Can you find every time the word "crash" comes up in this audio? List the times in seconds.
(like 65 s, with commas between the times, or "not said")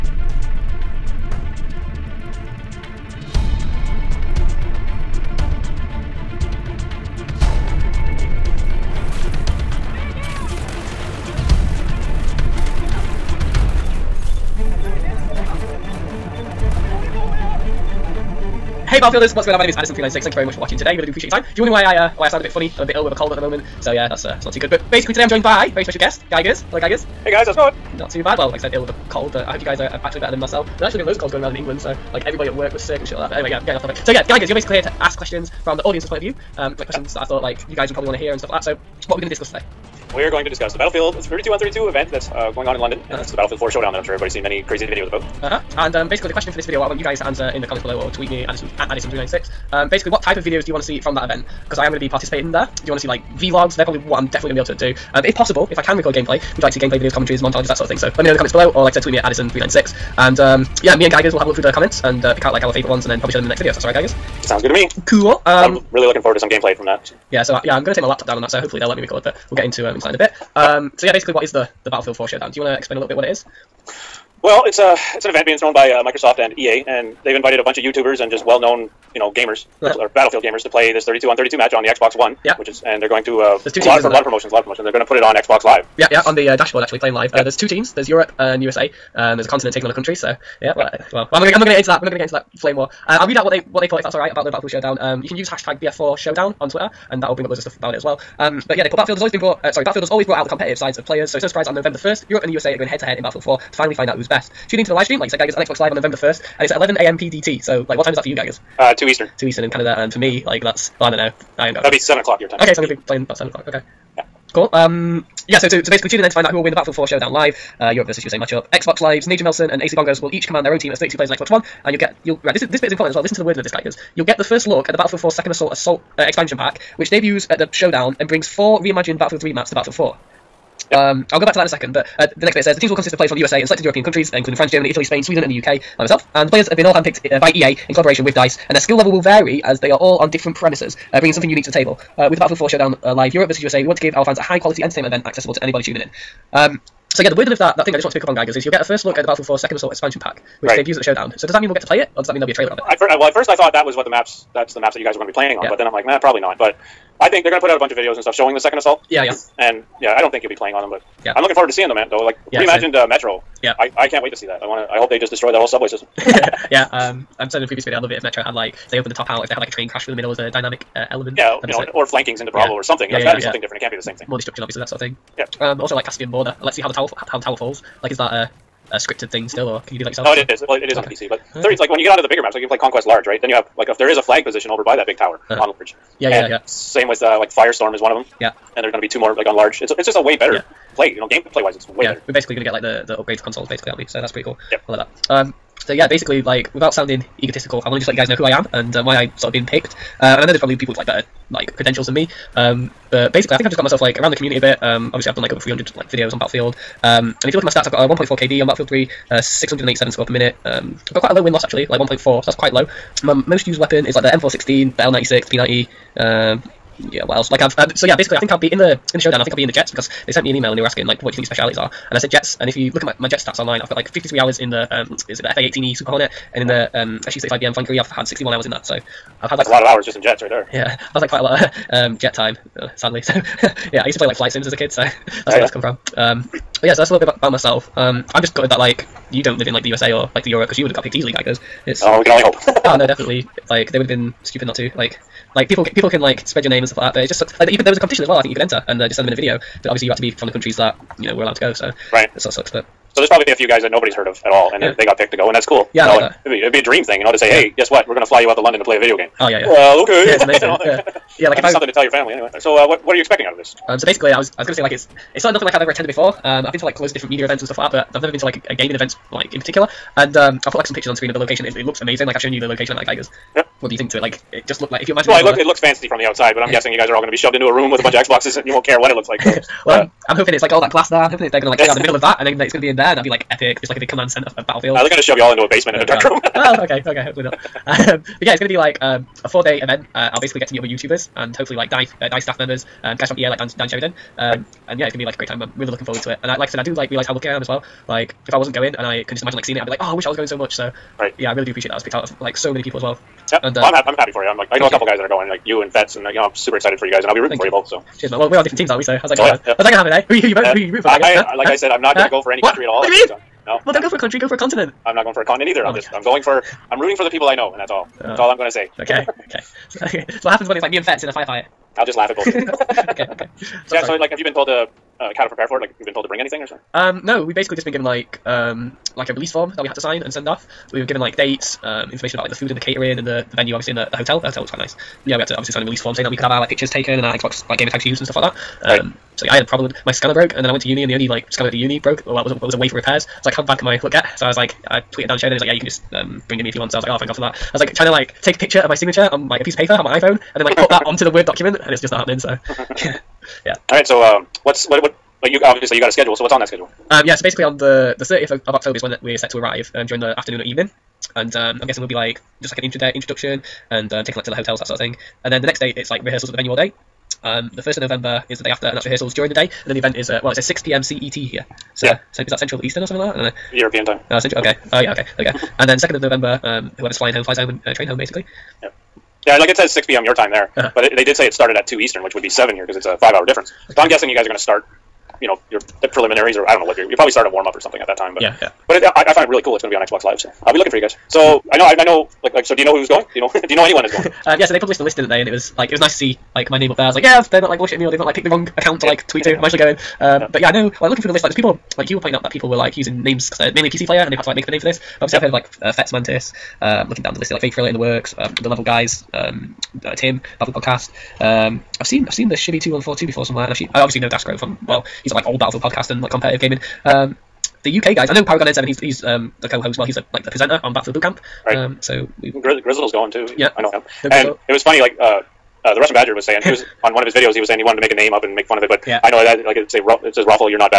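169 s.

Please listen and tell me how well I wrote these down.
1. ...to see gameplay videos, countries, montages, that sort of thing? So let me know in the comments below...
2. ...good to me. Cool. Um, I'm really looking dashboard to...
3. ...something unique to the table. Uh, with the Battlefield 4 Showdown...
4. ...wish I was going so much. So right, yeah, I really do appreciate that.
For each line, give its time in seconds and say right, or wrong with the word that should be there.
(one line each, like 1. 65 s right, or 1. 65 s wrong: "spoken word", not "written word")
1. 56 s wrong: "commentaries", not "countries"
2. 64 s wrong: "forward", not "dashboard"
3. 141 s right
4. 300 s right.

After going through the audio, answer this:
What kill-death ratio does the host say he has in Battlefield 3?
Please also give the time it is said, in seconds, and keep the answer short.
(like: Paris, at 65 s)
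1.4, at 208 s.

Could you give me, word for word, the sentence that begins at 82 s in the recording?
Yeah, which is, and they're going to uh, there's two teams, a lot of lot of promotions, a lot of promotions.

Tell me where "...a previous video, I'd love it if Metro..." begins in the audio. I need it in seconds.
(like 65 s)
167 s.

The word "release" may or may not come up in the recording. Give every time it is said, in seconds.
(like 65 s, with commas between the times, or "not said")
329 s, 335 s.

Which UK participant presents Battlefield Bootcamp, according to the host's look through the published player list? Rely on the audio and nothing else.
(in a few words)
Paragon N7.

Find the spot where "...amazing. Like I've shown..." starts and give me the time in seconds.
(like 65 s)
272 s.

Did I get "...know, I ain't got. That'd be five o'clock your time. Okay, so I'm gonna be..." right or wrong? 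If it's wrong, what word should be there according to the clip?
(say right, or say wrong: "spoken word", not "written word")
wrong: "seven", not "five".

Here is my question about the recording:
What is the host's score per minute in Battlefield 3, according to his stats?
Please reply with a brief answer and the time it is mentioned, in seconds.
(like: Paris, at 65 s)
687, at 209 s.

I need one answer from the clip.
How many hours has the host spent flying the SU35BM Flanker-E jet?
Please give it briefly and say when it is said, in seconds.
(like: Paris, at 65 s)
61 hours, at 228 s.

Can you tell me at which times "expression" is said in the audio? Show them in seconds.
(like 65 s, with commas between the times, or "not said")
not said.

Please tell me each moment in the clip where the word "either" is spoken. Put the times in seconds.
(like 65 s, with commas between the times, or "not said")
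315 s.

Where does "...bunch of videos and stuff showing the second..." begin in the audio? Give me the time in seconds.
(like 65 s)
157 s.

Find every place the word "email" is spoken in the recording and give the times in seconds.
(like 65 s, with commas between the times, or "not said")
220 s.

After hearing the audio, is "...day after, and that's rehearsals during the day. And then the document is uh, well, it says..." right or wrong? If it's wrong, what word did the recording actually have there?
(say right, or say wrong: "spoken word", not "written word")
wrong: "event", not "document".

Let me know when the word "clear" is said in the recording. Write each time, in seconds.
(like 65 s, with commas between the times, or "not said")
281 s.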